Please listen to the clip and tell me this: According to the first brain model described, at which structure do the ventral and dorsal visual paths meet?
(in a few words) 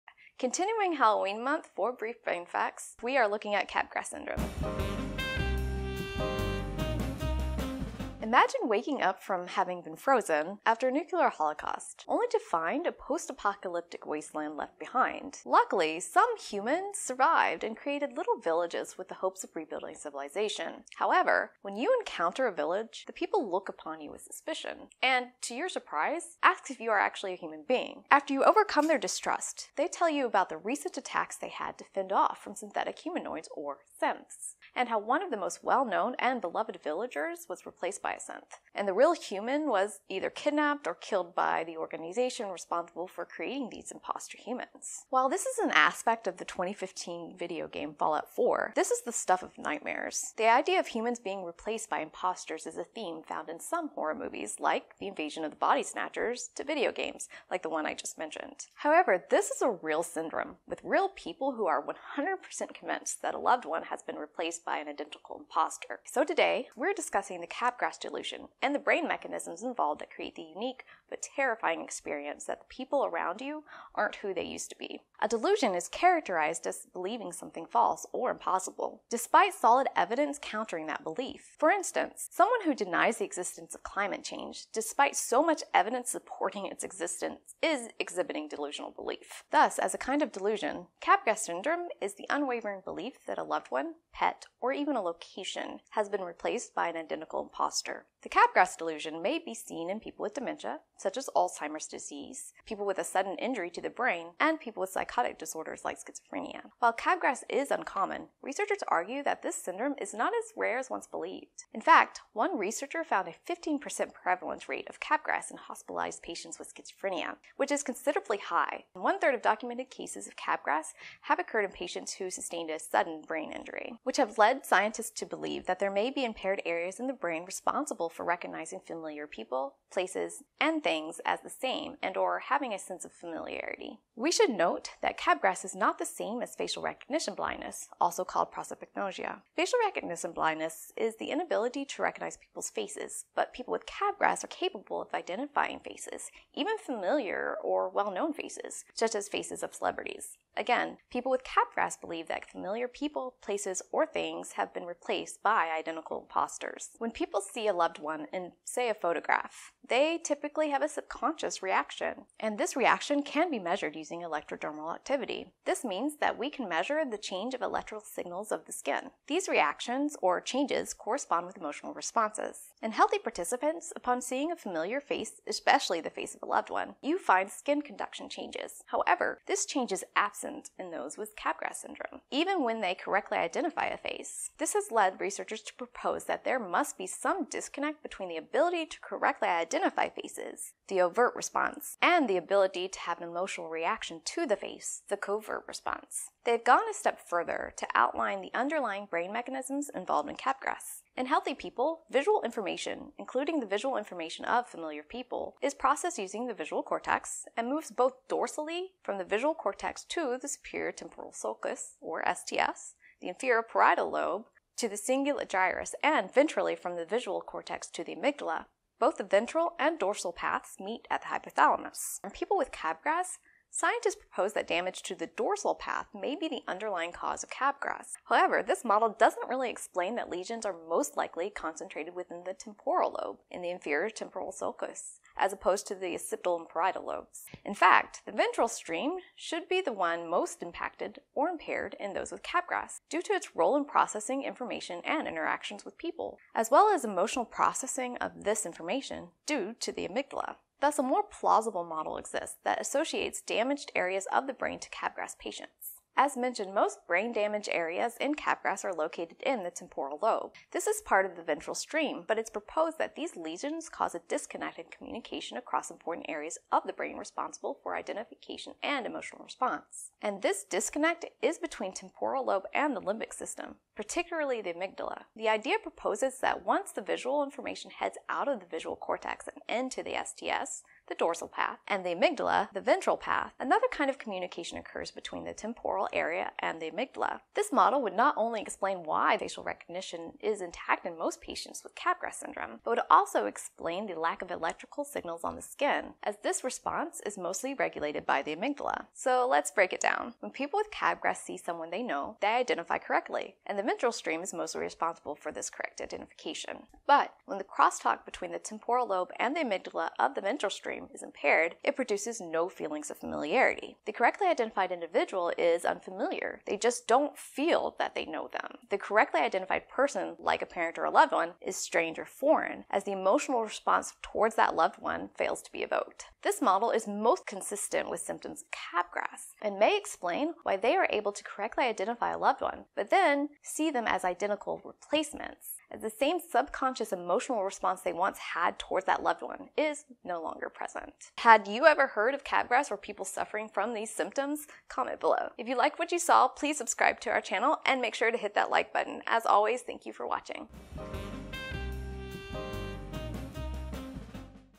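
hypothalamus.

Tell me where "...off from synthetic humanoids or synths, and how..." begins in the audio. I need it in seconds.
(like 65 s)
32 s.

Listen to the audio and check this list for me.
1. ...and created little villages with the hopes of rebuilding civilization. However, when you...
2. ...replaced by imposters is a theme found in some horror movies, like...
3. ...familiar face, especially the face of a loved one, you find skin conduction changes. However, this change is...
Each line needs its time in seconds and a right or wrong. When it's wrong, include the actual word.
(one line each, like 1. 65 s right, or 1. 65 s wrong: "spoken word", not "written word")
1. 17 s right
2. 51 s right
3. 174 s right.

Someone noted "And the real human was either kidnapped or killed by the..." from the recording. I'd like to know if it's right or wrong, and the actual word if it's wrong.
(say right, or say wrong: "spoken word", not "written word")
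right.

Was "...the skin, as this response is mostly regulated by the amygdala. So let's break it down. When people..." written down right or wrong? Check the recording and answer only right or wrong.
right.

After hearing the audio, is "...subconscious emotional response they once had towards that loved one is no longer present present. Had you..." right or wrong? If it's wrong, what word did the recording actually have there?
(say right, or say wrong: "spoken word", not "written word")
right.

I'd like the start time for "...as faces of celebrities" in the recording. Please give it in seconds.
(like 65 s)
149 s.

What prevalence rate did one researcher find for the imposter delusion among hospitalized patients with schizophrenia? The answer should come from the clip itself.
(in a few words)
15%.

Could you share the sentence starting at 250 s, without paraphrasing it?
Thus, a more plausible model exists that associates damaged areas of the brain to capgras patients.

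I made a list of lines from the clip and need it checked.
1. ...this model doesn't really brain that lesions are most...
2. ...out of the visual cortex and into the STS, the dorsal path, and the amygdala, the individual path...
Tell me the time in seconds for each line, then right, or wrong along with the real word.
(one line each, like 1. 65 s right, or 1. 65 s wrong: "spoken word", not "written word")
1. 228 s wrong: "explain", not "brain"
2. 278 s wrong: "ventral", not "individual".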